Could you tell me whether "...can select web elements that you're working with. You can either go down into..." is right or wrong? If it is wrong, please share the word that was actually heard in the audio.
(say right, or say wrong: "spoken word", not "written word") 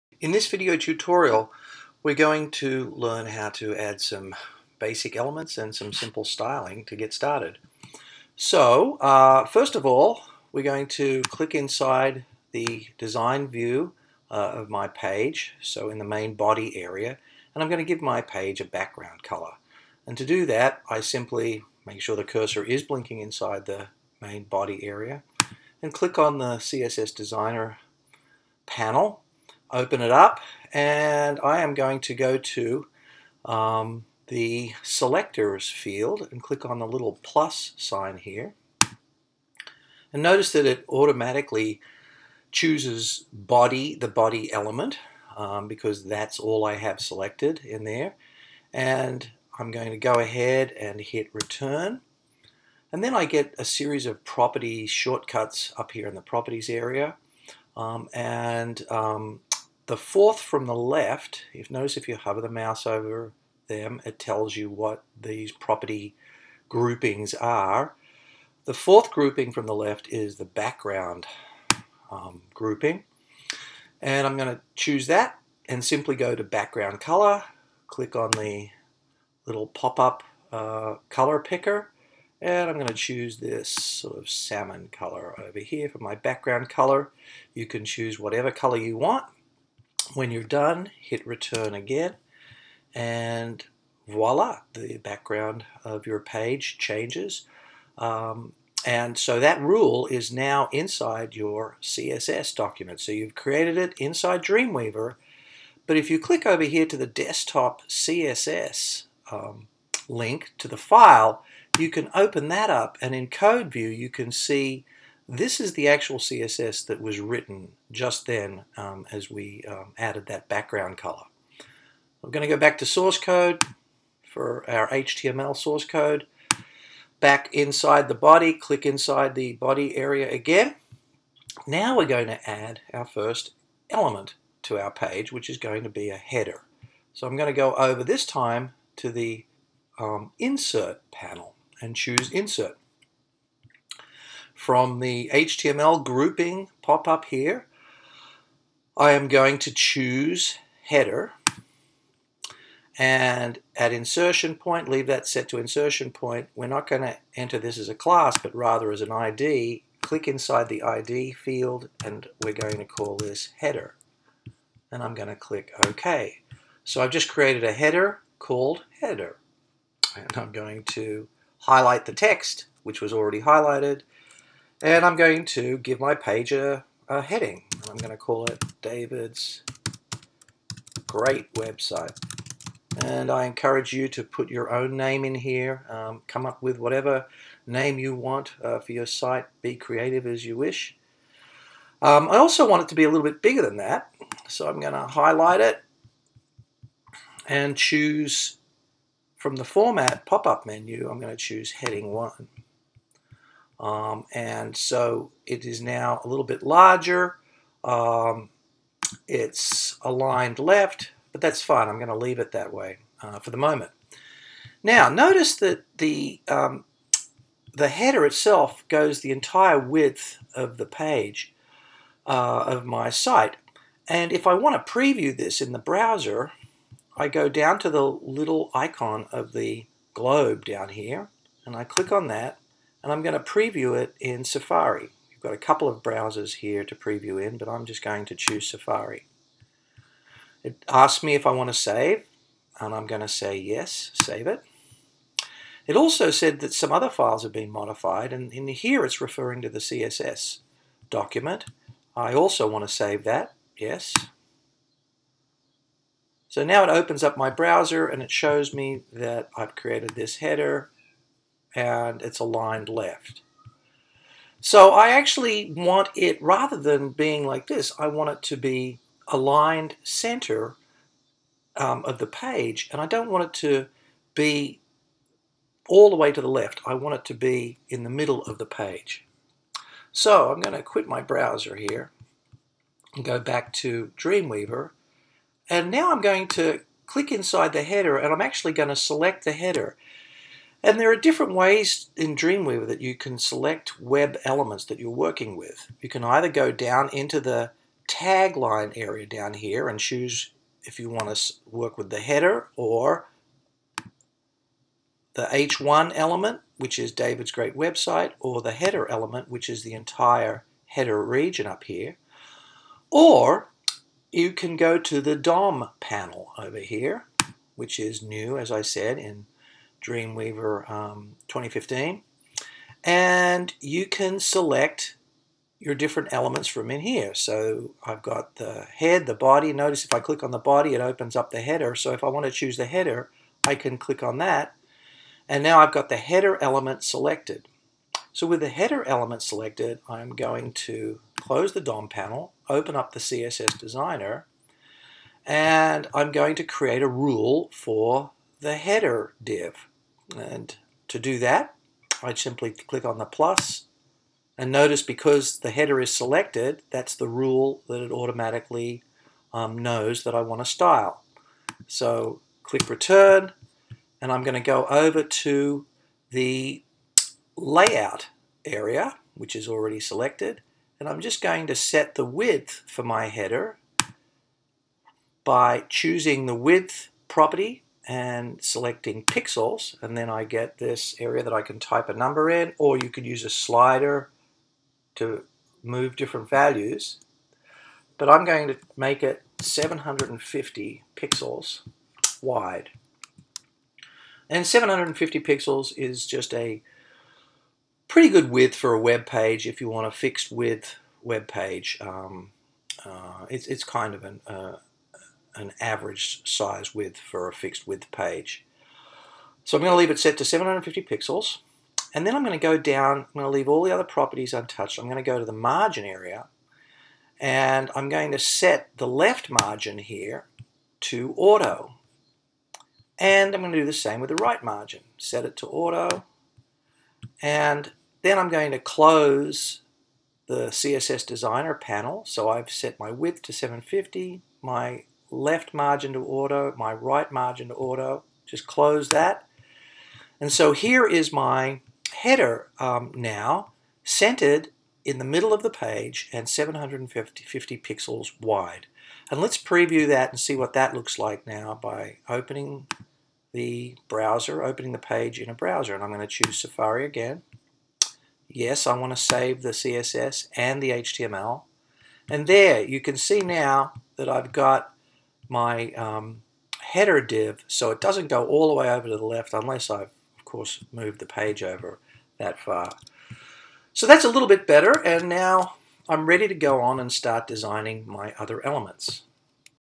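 right.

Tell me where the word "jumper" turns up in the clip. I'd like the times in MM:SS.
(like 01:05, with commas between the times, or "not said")
not said.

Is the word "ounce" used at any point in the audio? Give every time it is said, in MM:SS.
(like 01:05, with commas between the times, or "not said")
not said.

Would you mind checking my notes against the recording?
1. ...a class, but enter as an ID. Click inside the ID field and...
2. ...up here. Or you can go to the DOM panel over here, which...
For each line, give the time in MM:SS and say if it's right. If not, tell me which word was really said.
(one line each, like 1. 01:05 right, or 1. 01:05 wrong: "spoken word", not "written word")
1. 02:37 wrong: "rather", not "enter"
2. 05:11 right.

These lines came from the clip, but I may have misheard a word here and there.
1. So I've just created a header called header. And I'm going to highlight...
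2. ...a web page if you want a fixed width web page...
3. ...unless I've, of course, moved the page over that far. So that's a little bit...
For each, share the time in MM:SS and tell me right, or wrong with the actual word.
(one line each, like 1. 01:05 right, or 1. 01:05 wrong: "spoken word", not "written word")
1. 02:46 right
2. 06:38 right
3. 07:49 right.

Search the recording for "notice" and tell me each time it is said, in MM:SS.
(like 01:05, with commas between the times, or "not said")
00:40, 01:01, 03:35, 05:29, 05:54.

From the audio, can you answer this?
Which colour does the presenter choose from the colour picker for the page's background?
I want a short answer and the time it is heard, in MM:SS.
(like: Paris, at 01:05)
salmon, at 01:24.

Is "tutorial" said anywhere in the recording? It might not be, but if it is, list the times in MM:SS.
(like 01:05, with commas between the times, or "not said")
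00:00.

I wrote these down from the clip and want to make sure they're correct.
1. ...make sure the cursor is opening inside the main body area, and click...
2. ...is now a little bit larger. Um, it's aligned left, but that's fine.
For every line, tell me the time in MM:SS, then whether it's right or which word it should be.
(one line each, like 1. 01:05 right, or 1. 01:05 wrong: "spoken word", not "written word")
1. 00:21 wrong: "blinking", not "opening"
2. 03:25 right.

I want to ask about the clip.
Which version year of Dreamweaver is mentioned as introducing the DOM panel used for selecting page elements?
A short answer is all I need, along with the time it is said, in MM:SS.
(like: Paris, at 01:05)
2015, at 05:21.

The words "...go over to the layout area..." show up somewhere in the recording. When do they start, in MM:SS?
06:04.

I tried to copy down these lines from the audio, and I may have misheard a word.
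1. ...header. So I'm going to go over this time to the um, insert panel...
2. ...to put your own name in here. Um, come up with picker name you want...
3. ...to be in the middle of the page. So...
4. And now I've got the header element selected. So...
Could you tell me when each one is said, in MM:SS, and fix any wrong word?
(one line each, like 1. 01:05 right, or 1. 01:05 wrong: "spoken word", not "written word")
1. 02:16 right
2. 03:04 wrong: "whatever", not "picker"
3. 04:37 right
4. 05:35 right.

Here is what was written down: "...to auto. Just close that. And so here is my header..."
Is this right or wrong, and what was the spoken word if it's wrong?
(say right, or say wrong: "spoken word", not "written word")
right.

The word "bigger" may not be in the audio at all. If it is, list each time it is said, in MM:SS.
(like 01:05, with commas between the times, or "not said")
03:13.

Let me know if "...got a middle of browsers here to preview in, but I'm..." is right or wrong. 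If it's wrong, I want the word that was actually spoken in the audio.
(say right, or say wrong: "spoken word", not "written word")
wrong: "couple", not "middle".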